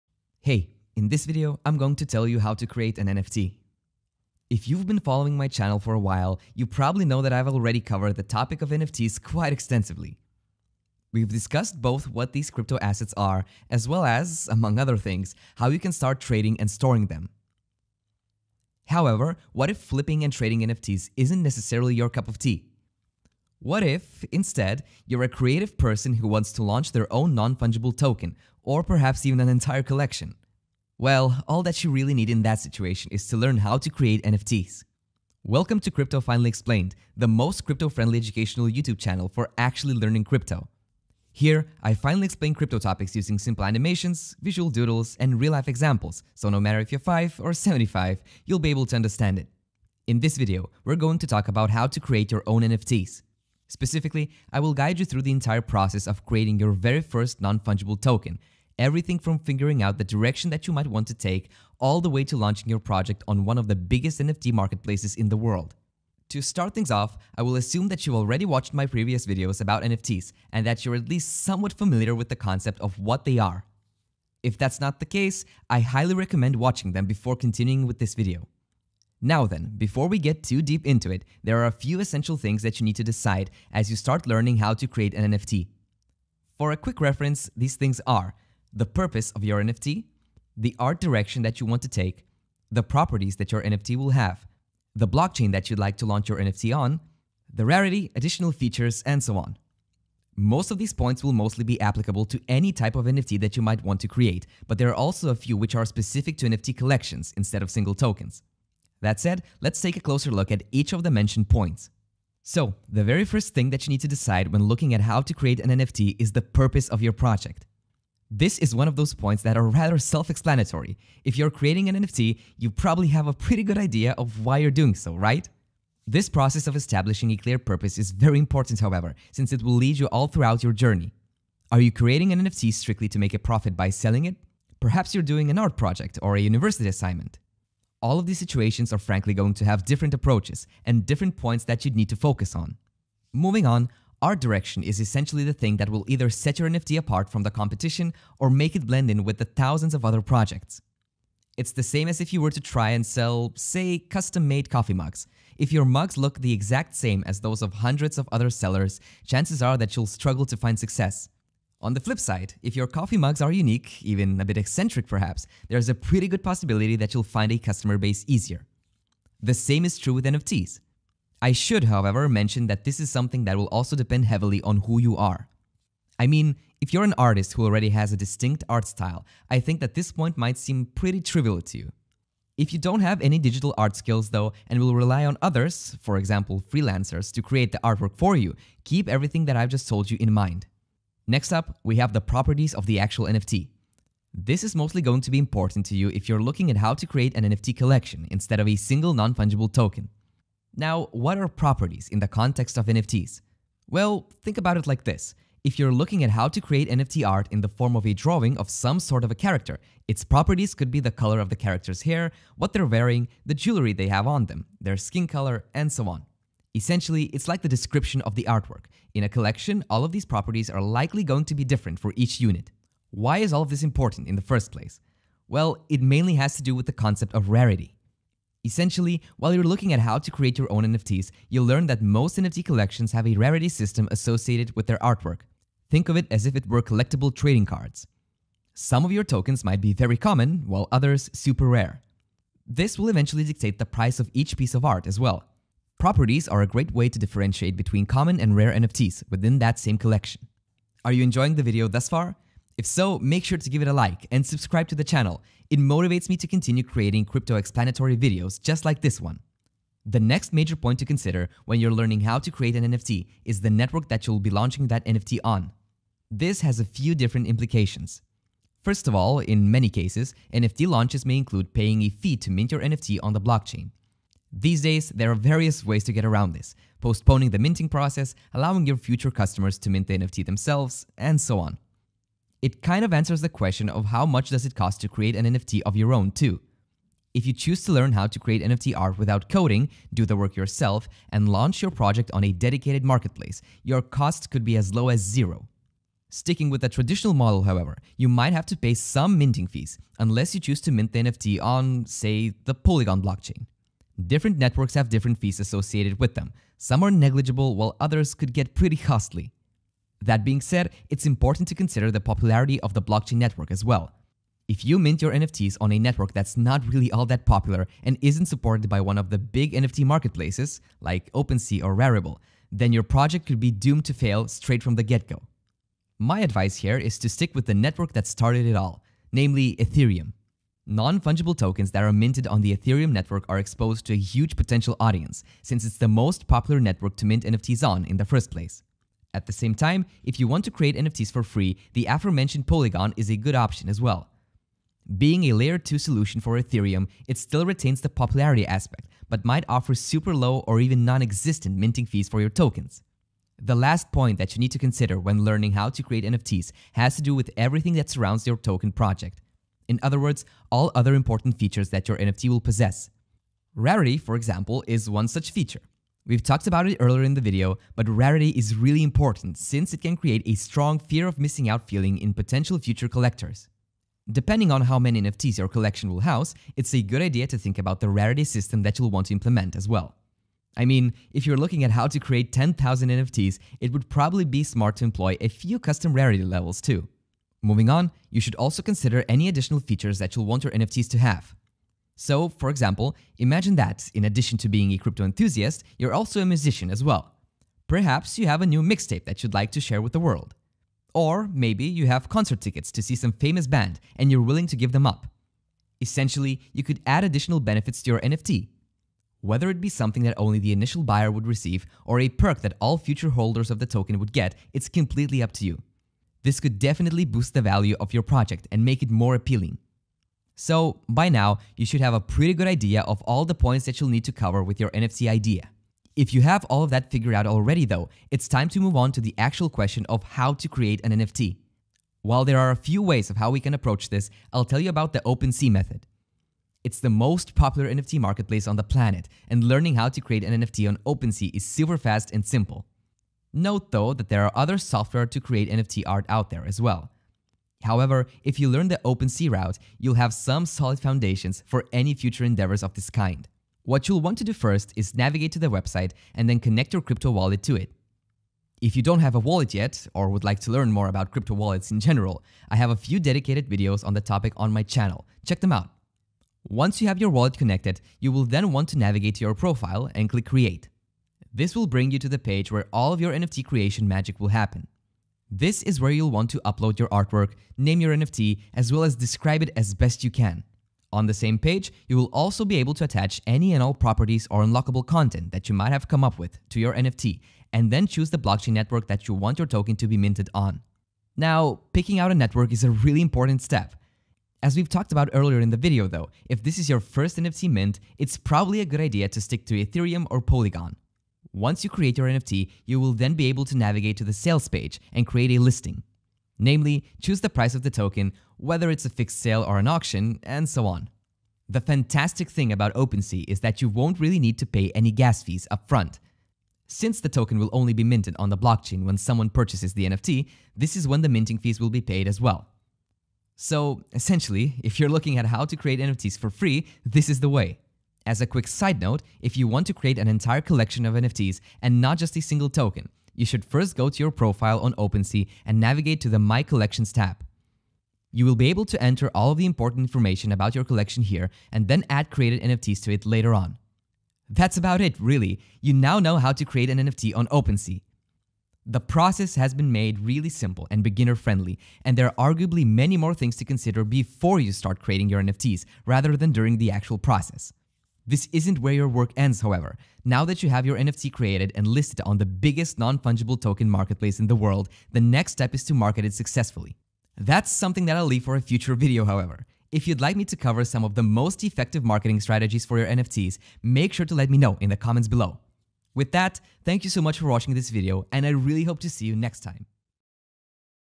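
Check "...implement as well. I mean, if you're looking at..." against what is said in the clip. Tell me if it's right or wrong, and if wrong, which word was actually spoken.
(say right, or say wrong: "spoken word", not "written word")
right.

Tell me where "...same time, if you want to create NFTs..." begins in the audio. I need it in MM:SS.
05:39.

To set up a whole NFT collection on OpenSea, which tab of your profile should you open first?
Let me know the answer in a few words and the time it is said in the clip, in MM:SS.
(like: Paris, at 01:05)
My Collections, at 08:56.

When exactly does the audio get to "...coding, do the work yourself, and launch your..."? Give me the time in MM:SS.
04:49.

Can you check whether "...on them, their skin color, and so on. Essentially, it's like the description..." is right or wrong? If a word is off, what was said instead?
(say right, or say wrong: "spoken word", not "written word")
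right.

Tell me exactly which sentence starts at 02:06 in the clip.
This process of establishing a clear purpose is very important, however, since it will lead you all throughout your journey.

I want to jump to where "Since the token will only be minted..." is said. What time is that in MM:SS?
08:36.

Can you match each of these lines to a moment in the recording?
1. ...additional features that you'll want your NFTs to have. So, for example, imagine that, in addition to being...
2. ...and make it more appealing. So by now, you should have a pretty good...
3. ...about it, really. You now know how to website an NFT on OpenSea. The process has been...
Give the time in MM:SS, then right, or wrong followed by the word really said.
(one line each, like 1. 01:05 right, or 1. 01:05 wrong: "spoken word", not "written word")
1. 06:29 right
2. 06:58 right
3. 09:04 wrong: "create", not "website".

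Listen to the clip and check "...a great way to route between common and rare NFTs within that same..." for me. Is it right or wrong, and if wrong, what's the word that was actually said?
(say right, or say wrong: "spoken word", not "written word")
wrong: "differentiate", not "route".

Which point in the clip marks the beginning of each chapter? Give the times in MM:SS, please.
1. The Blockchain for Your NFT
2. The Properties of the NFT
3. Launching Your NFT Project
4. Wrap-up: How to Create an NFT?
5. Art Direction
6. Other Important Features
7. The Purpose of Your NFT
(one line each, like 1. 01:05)
1. 04:19
2. 03:11
3. 07:07
4. 09:03
5. 02:22
6. 05:53
7. 01:51.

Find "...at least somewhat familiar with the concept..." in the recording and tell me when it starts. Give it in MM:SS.
01:10.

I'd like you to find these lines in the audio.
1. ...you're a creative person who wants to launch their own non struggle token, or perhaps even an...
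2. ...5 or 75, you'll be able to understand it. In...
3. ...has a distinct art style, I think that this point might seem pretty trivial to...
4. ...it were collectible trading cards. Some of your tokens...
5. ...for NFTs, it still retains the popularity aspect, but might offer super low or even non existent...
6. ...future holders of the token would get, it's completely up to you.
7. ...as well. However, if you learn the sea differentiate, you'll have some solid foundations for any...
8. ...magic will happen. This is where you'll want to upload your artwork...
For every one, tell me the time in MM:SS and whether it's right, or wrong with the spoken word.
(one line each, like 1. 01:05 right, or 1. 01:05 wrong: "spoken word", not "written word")
1. 00:25 wrong: "fungible", not "struggle"
2. 00:46 right
3. 02:57 right
4. 03:56 right
5. 05:46 wrong: "Ethereum", not "NFTs"
6. 06:52 right
7. 07:26 wrong: "route", not "differentiate"
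8. 07:54 right.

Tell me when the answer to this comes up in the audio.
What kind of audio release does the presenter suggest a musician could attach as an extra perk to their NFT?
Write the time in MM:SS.
06:38.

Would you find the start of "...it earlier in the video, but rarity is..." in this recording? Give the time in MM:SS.
06:06.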